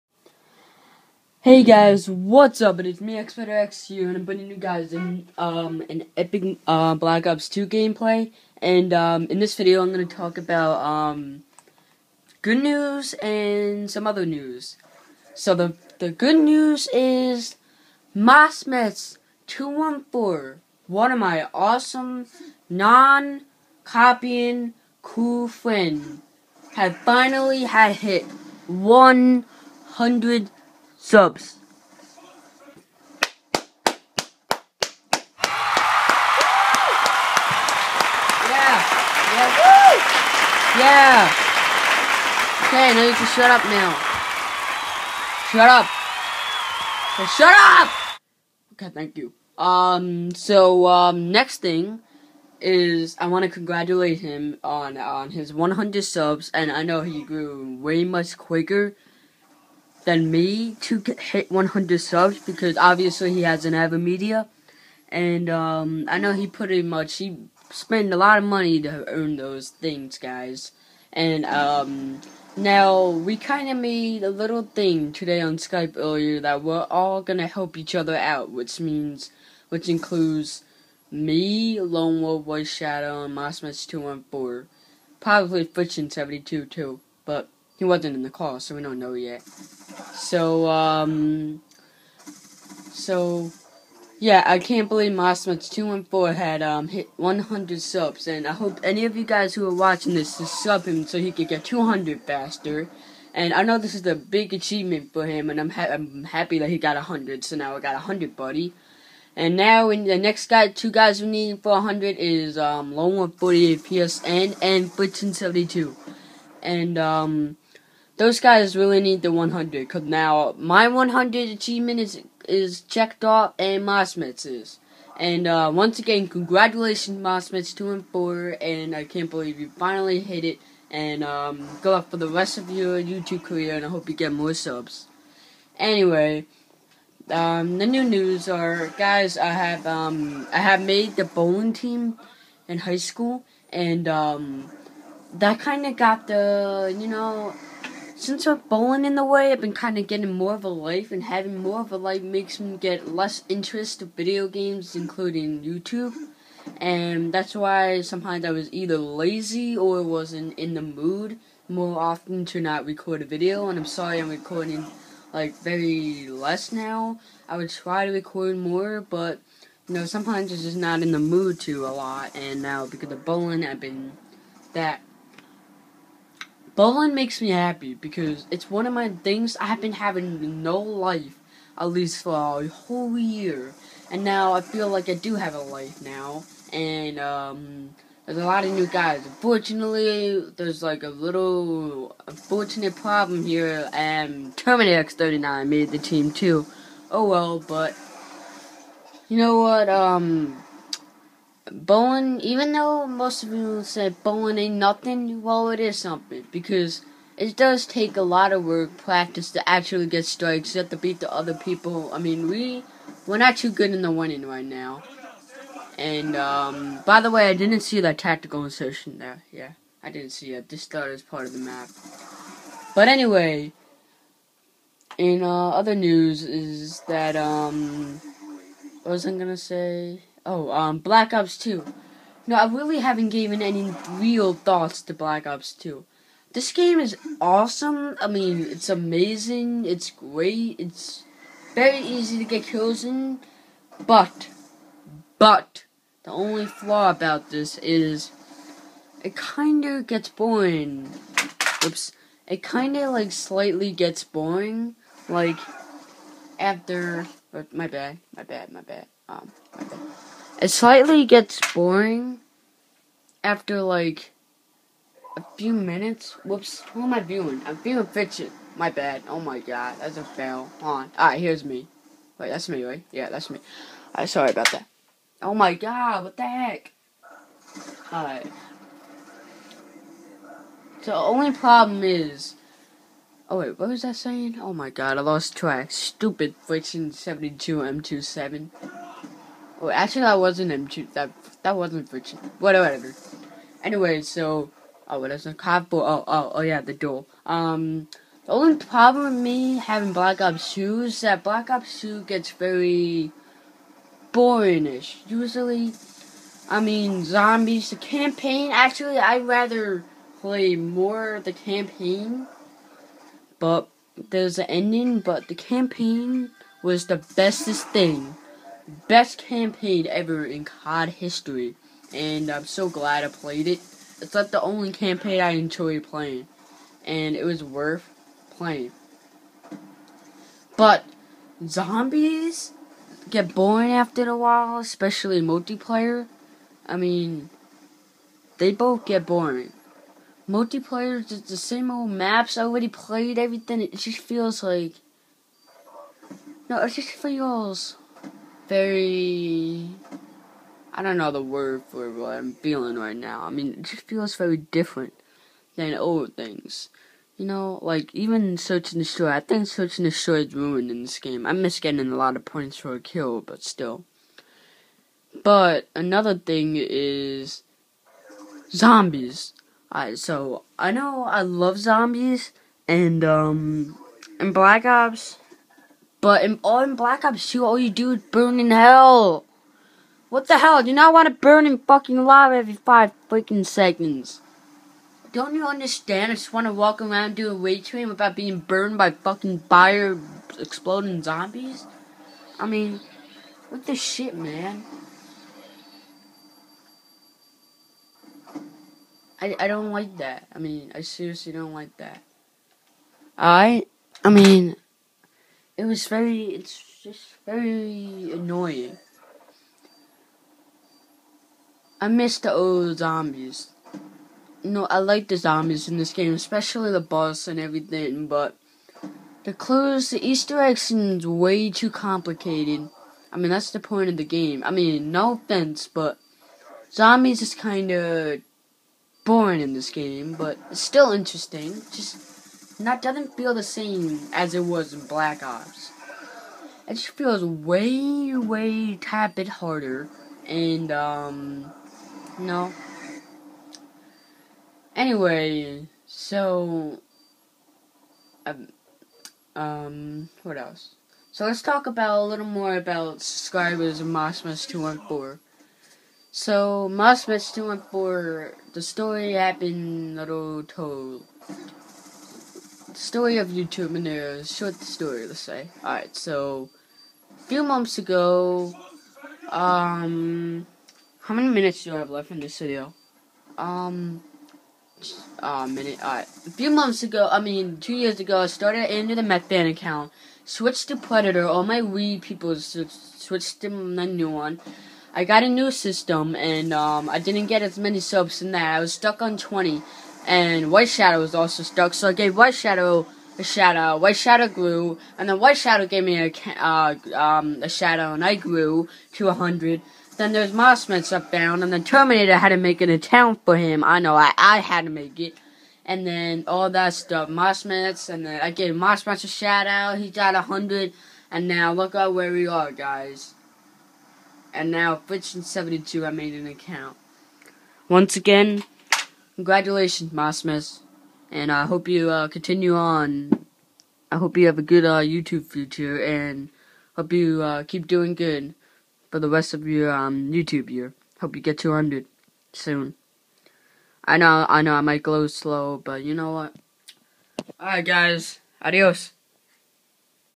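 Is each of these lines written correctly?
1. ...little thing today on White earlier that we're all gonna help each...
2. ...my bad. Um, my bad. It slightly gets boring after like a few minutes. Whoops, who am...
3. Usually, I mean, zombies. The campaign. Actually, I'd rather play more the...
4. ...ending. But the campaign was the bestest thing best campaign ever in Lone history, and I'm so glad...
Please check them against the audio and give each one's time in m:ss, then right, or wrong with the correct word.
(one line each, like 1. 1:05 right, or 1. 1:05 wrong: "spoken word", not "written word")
1. 1:14 wrong: "Skype", not "White"
2. 4:18 right
3. 5:05 right
4. 5:14 wrong: "COD", not "Lone".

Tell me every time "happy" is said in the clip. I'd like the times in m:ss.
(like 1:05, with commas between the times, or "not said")
1:46, 2:57.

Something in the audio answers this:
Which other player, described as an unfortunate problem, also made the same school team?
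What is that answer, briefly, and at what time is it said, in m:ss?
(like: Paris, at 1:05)
Terminator X39, at 3:14.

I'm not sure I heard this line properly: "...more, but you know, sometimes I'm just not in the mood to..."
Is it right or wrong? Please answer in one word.
right.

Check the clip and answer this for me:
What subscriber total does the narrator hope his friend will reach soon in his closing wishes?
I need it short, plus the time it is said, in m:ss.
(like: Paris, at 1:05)
200, at 8:51.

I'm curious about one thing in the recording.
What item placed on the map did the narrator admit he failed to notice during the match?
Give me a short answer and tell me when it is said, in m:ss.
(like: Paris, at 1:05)
tactical insertion, at 3:38.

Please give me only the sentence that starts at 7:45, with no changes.
Alright, so a few months ago, um, how many minutes do I have left in this video?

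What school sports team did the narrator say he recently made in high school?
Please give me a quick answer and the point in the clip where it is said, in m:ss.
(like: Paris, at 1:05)
bowling team, at 2:21.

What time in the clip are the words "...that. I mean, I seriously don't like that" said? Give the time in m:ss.
6:40.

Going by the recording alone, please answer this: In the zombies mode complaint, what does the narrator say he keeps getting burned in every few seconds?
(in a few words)
lava.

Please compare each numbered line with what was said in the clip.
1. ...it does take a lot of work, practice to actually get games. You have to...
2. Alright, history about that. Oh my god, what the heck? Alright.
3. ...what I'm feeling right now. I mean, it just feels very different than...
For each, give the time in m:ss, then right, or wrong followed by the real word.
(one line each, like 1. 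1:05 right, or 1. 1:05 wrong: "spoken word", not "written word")
1. 3:27 wrong: "strikes", not "games"
2. 4:34 wrong: "sorry", not "history"
3. 5:52 right.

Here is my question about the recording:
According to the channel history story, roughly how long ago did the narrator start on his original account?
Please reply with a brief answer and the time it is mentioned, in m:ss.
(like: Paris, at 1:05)
2 years ago, at 7:57.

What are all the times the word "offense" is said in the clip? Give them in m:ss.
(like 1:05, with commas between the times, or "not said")
7:05.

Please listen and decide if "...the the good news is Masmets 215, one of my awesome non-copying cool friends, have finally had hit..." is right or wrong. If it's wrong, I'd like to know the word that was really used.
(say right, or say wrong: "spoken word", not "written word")
wrong: "214", not "215".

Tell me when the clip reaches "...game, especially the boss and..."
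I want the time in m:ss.
6:56.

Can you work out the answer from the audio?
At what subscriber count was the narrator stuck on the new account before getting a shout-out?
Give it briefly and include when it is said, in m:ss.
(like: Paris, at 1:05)
20, at 8:08.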